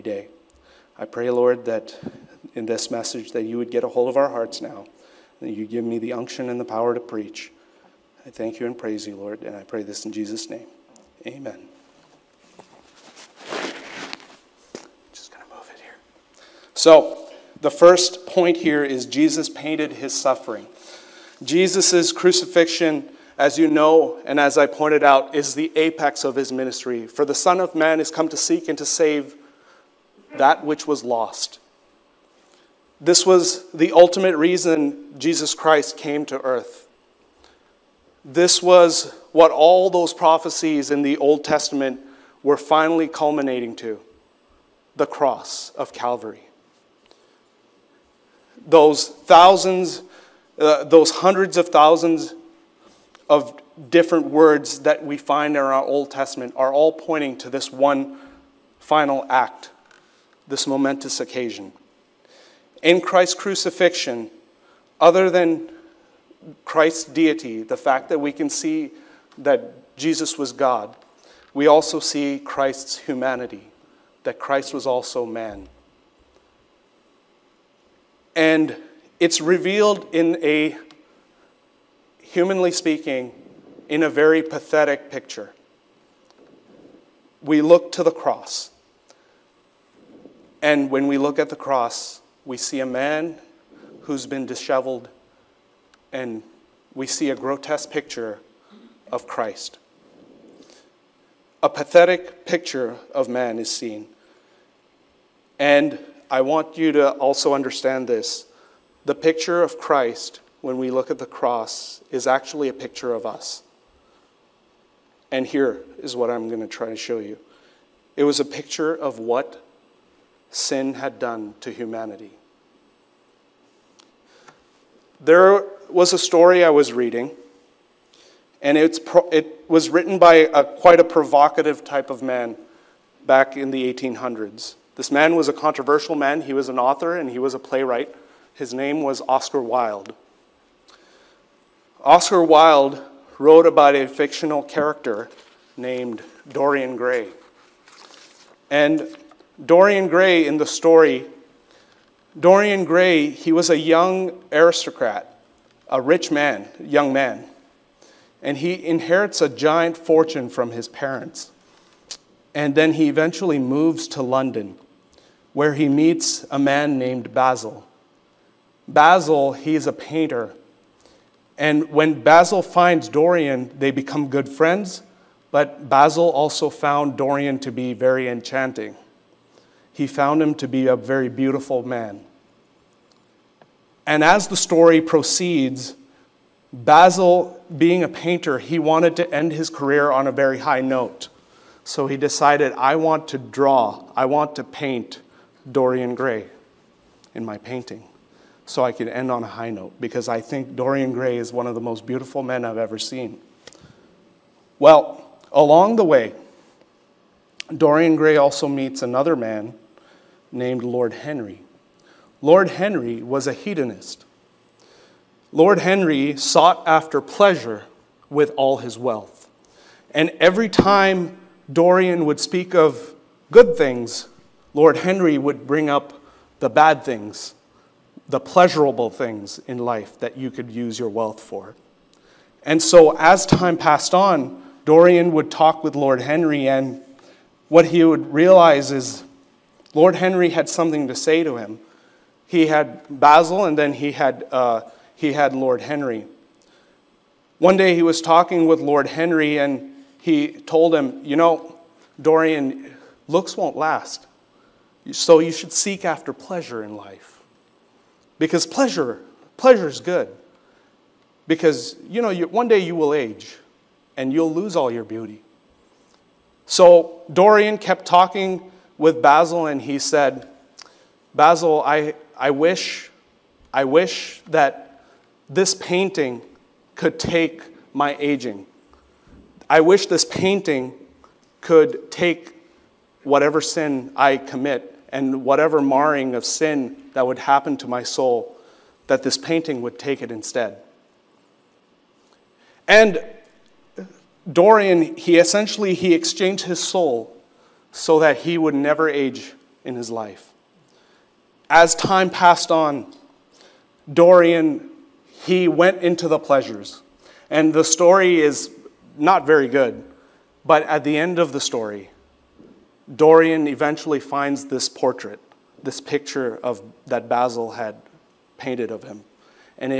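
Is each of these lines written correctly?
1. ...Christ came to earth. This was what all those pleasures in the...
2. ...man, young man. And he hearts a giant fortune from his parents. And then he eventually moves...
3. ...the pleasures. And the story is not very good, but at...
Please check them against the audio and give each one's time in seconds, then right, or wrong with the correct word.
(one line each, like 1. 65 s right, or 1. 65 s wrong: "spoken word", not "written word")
1. 35 s wrong: "prophecies", not "pleasures"
2. 156 s wrong: "inherits", not "hearts"
3. 306 s right.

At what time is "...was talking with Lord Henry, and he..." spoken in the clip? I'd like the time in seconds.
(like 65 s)
248 s.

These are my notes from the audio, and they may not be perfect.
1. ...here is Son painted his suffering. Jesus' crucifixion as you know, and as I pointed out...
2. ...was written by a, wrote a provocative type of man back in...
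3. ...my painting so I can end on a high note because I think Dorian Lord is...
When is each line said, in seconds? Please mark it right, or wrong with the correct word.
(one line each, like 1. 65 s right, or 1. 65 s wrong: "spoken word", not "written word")
1. 18 s wrong: "Jesus", not "Son"
2. 129 s wrong: "quite", not "wrote"
3. 197 s wrong: "Gray", not "Lord".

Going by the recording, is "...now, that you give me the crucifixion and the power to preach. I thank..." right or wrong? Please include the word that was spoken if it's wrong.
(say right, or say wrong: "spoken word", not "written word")
wrong: "unction", not "crucifixion".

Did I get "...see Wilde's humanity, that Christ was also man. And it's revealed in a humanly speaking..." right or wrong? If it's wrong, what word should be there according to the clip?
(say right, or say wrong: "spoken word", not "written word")
wrong: "Christ", not "Wilde".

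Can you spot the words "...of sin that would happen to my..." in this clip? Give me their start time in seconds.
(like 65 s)
286 s.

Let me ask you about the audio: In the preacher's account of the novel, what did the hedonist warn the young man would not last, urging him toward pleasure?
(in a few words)
looks.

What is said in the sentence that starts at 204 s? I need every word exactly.
Well, along the way, Dorian Gray also meets another man named Lord Henry.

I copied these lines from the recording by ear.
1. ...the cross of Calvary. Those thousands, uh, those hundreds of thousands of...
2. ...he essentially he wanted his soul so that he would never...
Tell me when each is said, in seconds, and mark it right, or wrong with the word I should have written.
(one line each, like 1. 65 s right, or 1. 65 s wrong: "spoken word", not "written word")
1. 44 s right
2. 295 s wrong: "exchanged", not "wanted".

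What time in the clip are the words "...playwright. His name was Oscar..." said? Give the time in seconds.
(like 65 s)
137 s.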